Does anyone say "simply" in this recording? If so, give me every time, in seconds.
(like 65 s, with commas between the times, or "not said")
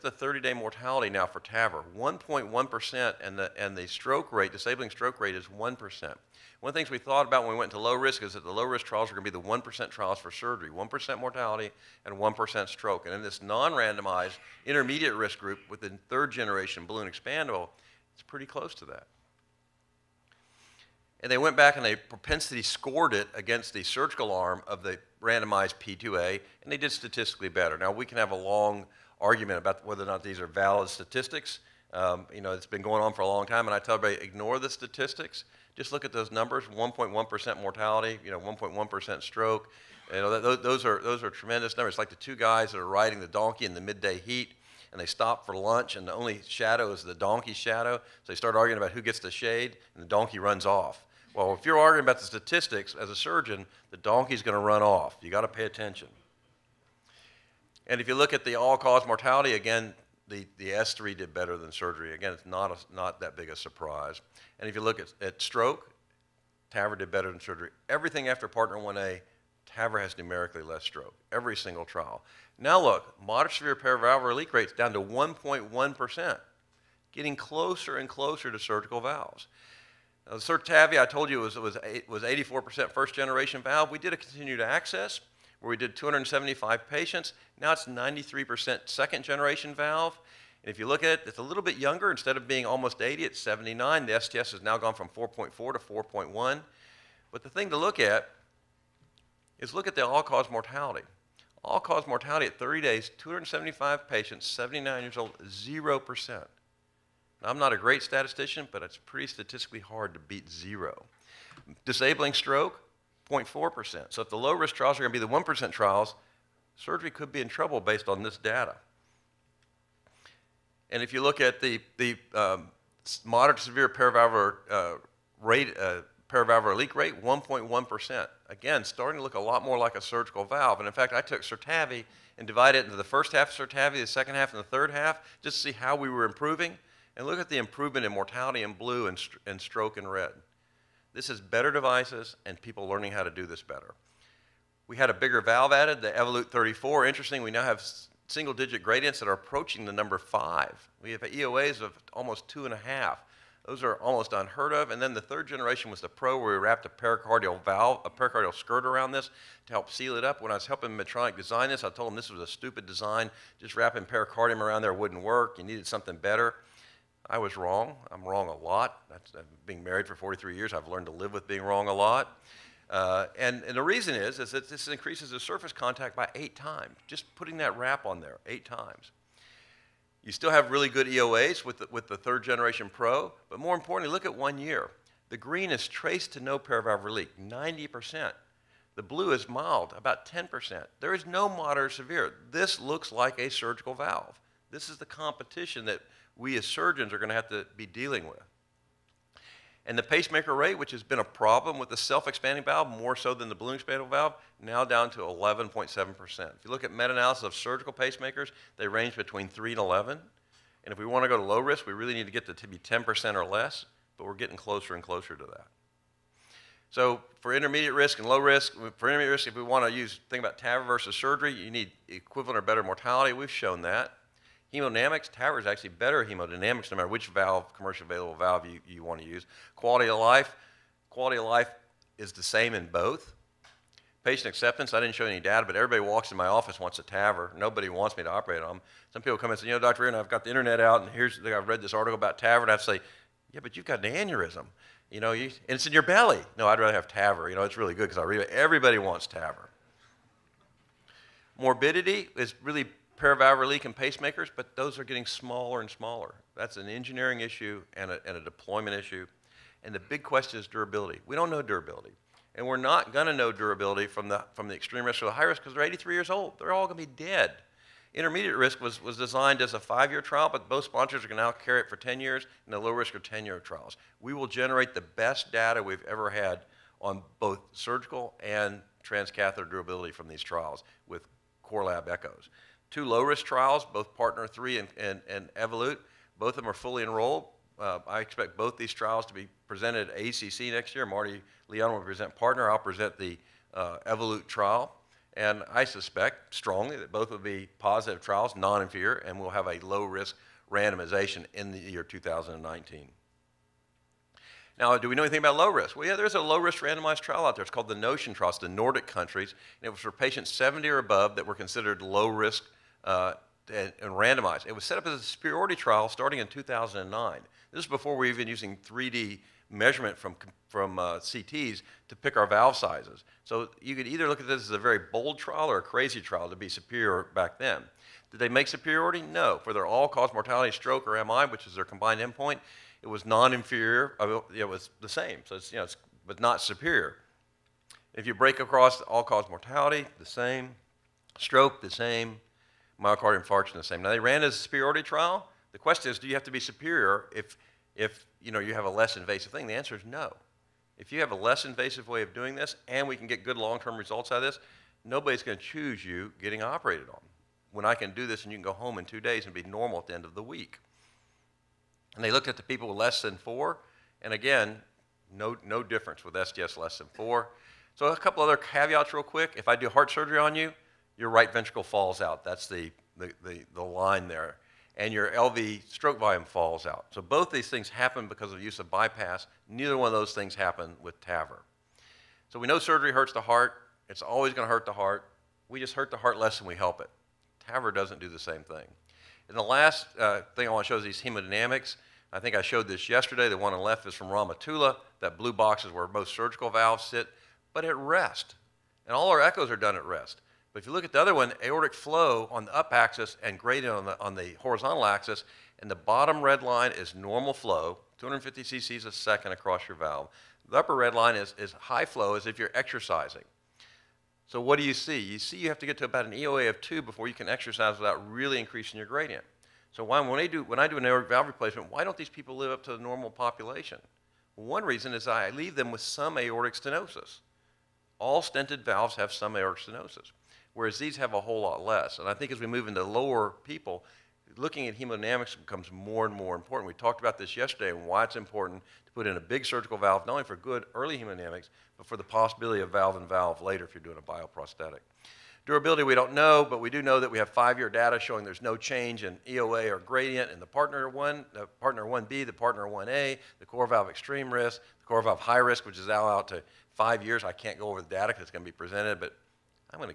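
not said.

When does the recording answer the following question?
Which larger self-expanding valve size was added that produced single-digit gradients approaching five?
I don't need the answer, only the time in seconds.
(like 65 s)
146 s.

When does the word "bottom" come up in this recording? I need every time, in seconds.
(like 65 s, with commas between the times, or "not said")
405 s.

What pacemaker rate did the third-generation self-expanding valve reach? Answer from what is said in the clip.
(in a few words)
11.7%.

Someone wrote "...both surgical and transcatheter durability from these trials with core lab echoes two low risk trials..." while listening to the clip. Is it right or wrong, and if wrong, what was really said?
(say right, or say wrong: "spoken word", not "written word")
right.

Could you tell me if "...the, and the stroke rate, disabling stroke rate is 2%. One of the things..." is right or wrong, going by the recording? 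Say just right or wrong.
wrong.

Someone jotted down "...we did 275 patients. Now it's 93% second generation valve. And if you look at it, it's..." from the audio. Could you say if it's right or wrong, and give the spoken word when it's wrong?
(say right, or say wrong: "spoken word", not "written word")
right.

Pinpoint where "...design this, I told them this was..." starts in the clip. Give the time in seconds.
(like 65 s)
161 s.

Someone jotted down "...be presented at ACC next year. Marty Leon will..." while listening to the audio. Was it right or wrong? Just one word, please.
right.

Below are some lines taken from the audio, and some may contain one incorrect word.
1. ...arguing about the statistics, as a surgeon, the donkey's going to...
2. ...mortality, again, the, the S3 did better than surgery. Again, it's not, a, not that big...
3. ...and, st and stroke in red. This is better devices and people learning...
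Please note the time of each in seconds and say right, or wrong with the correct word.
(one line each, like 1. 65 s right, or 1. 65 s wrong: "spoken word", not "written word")
1. 51 s right
2. 59 s right
3. 139 s right.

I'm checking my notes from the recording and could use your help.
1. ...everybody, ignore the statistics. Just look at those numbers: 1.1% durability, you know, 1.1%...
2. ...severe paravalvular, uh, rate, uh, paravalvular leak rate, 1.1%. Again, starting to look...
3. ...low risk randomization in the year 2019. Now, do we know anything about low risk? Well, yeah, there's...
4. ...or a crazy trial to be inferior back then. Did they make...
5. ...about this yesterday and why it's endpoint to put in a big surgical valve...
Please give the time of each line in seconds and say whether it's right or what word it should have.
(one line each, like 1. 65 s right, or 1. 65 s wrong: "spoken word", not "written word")
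1. 33 s wrong: "mortality", not "durability"
2. 123 s right
3. 299 s right
4. 325 s wrong: "superior", not "inferior"
5. 437 s wrong: "important", not "endpoint".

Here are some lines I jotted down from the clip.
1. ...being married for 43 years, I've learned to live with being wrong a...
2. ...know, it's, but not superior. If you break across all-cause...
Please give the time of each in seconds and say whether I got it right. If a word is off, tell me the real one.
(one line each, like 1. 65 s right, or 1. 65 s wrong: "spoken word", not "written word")
1. 169 s right
2. 335 s right.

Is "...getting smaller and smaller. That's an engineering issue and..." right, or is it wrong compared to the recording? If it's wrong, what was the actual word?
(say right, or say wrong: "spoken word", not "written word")
right.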